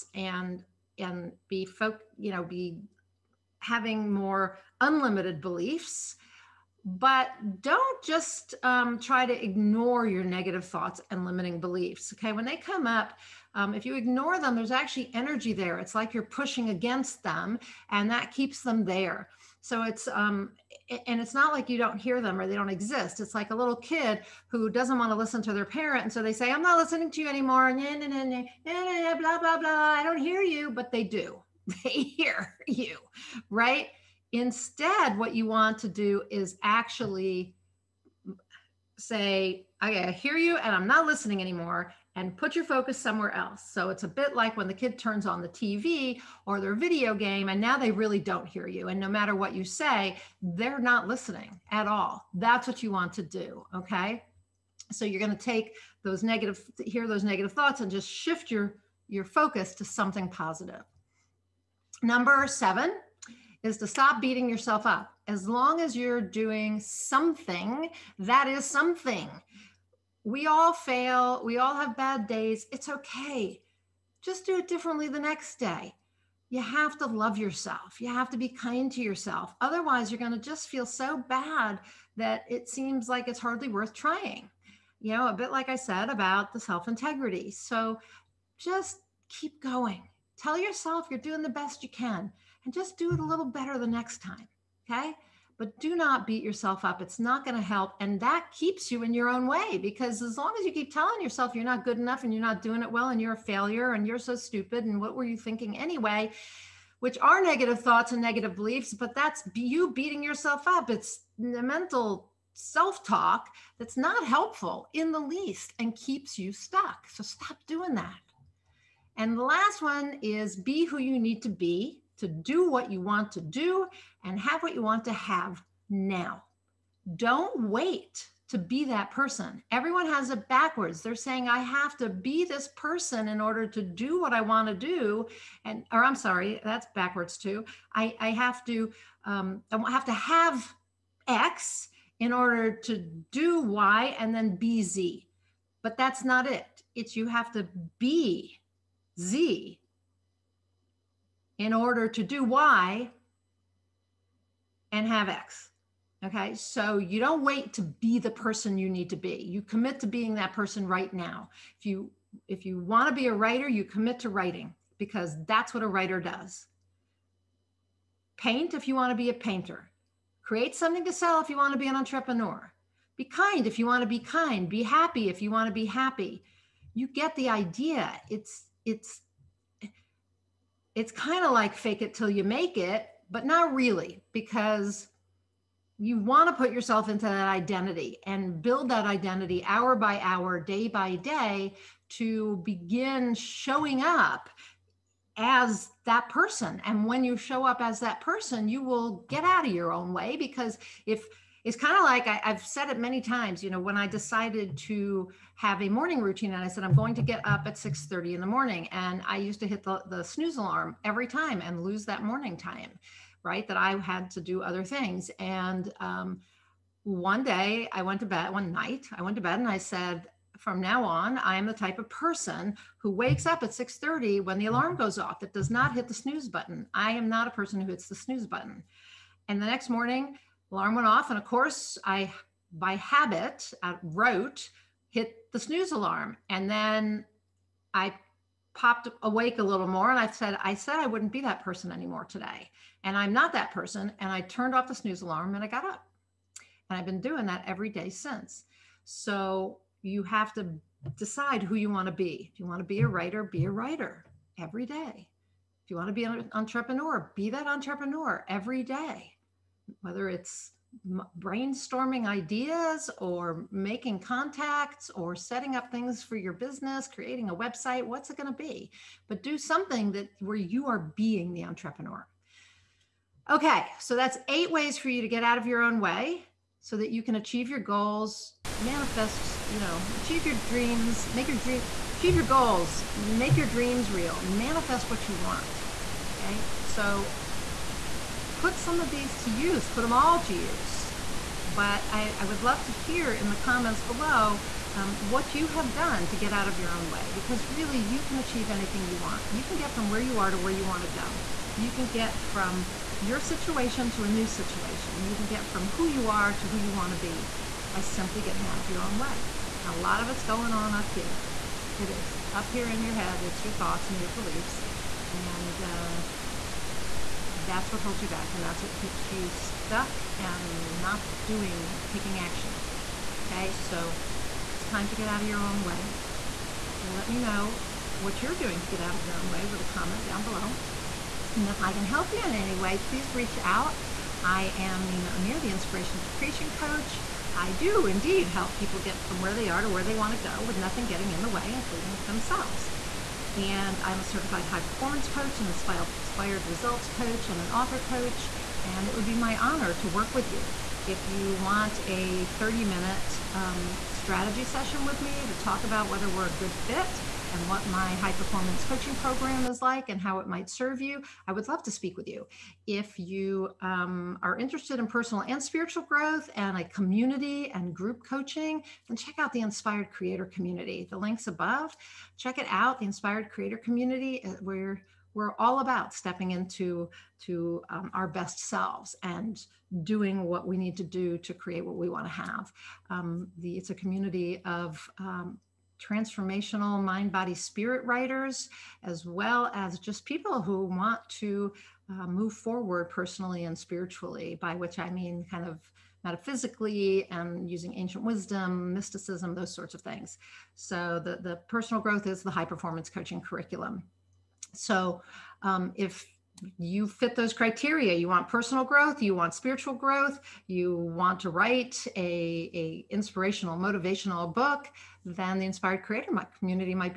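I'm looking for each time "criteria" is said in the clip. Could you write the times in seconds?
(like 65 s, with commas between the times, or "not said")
407 s.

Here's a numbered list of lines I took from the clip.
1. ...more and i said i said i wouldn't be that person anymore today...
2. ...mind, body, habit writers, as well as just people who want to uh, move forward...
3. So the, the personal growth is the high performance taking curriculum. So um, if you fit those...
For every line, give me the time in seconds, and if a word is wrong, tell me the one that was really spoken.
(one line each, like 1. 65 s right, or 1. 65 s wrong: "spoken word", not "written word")
1. 239 s right
2. 387 s wrong: "spirit", not "habit"
3. 400 s wrong: "coaching", not "taking".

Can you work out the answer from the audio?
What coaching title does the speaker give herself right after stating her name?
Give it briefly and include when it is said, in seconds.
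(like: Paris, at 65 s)
Inspiration to Creation Coach, at 335 s.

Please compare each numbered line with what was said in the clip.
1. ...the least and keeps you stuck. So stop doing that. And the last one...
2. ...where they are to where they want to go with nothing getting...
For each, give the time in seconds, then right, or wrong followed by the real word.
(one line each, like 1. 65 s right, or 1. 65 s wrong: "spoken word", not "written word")
1. 115 s right
2. 339 s right.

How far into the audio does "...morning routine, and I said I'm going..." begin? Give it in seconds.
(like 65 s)
205 s.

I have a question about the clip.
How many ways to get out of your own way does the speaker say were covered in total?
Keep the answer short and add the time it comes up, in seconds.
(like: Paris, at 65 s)
8, at 274 s.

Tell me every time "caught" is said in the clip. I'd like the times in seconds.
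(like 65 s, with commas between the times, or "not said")
not said.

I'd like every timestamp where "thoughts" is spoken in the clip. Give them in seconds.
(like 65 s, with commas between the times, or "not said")
10 s, 57 s, 107 s, 313 s.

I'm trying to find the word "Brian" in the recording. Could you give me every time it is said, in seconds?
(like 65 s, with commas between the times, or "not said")
not said.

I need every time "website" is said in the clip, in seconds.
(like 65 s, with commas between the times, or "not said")
267 s.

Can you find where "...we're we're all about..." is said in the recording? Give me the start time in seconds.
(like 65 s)
374 s.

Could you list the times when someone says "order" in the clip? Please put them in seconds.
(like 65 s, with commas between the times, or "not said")
133 s, 142 s, 151 s.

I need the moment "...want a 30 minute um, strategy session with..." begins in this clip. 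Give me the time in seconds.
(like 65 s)
351 s.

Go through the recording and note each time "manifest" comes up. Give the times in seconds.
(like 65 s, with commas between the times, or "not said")
278 s, 284 s.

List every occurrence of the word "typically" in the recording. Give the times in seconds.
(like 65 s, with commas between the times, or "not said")
not said.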